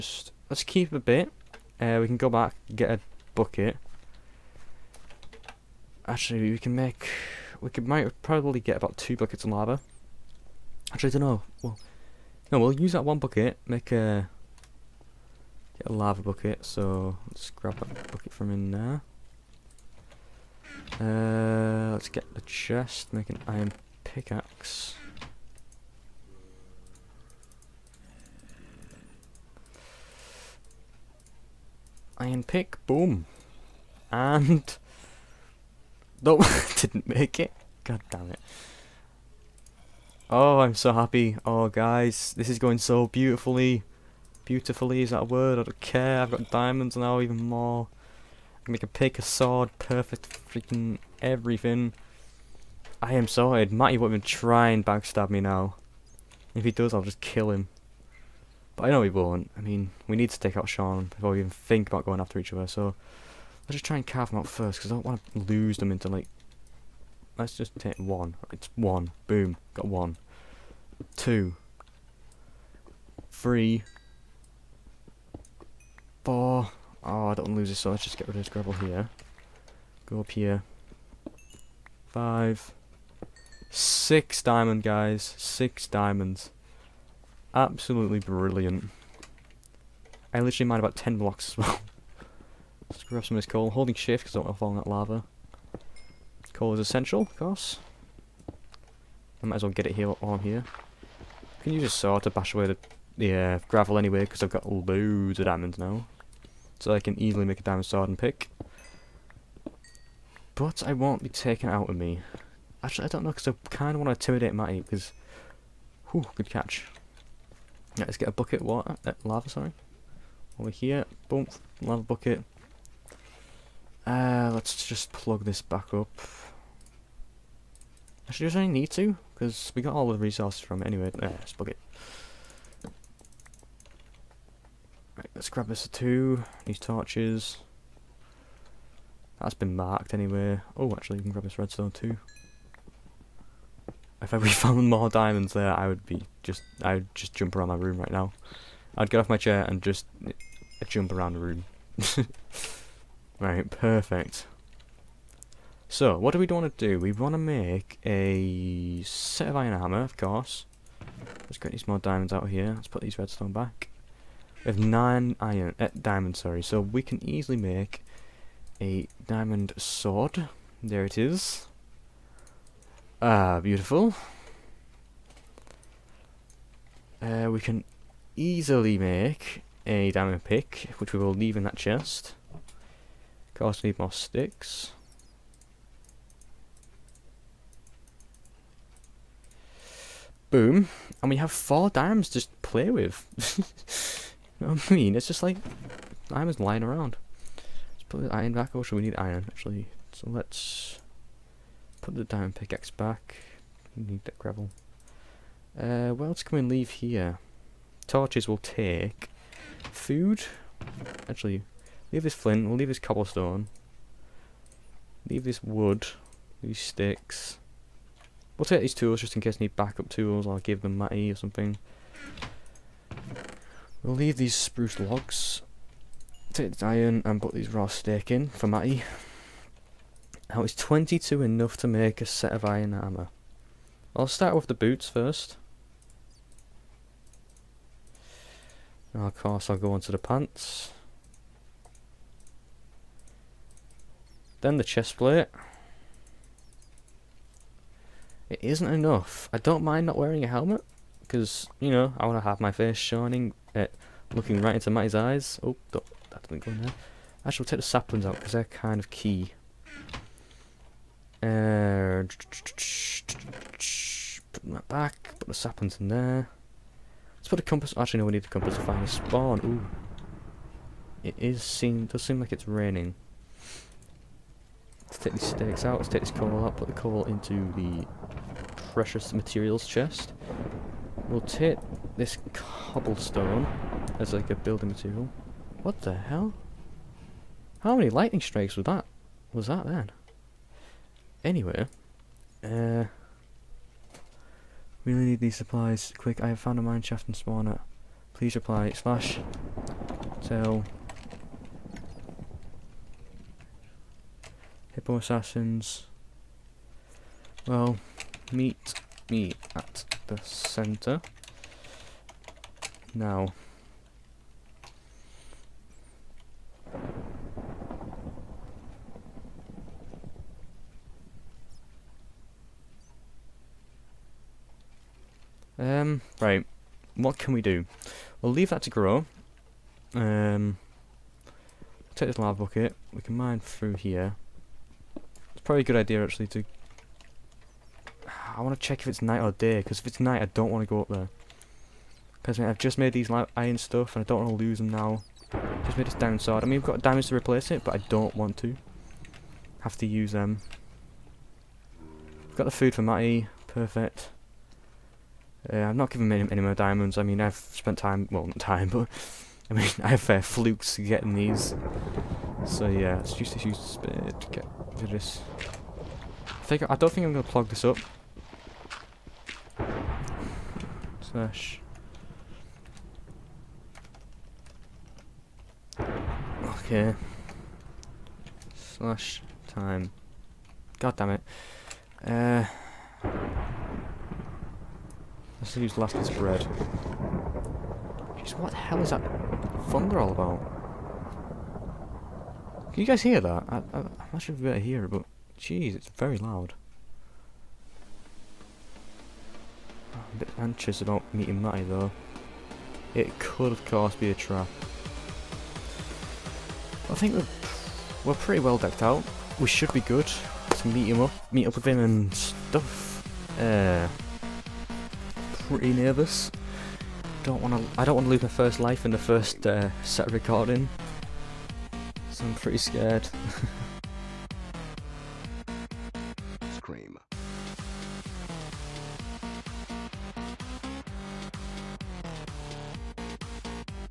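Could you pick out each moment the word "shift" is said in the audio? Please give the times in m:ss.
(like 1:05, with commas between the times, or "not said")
1:33.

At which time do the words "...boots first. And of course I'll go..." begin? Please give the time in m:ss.
3:54.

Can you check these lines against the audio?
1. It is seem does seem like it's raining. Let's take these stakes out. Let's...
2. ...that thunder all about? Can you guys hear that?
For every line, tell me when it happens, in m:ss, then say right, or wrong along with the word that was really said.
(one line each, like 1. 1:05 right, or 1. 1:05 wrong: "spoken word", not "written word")
1. 4:31 right
2. 6:29 right.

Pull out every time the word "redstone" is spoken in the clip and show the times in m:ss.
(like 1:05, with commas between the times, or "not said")
2:21, 2:43.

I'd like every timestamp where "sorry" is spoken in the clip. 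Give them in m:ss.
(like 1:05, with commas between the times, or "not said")
1:59, 2:46.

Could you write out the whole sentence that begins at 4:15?
Oh, that didn't go in there.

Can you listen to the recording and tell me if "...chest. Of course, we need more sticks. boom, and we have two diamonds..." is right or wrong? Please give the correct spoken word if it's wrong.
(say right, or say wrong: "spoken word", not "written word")
wrong: "four", not "two".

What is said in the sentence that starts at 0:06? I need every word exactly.
Actually, we can make, we could might probably get about two buckets of lava.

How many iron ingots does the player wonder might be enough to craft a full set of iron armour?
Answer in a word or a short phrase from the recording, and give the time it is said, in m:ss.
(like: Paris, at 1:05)
22, at 3:50.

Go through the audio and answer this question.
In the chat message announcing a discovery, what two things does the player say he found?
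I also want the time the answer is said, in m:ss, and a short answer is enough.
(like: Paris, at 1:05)
Mine shaft and spawner, at 4:56.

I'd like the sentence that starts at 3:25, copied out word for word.
Uh, what else can we leave here?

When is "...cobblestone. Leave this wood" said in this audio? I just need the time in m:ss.
3:33.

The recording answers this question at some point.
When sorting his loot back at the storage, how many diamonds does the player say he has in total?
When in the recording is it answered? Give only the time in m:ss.
2:44.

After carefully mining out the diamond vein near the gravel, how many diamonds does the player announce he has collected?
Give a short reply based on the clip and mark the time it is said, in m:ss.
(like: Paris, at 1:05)
6, at 1:25.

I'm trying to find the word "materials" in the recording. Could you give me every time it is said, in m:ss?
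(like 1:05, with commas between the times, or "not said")
4:39, 4:44.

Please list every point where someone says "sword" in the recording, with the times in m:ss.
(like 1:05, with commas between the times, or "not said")
0:49, 1:47, 2:49, 5:46.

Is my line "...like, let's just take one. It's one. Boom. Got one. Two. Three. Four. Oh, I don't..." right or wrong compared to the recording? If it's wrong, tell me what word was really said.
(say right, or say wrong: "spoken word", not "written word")
right.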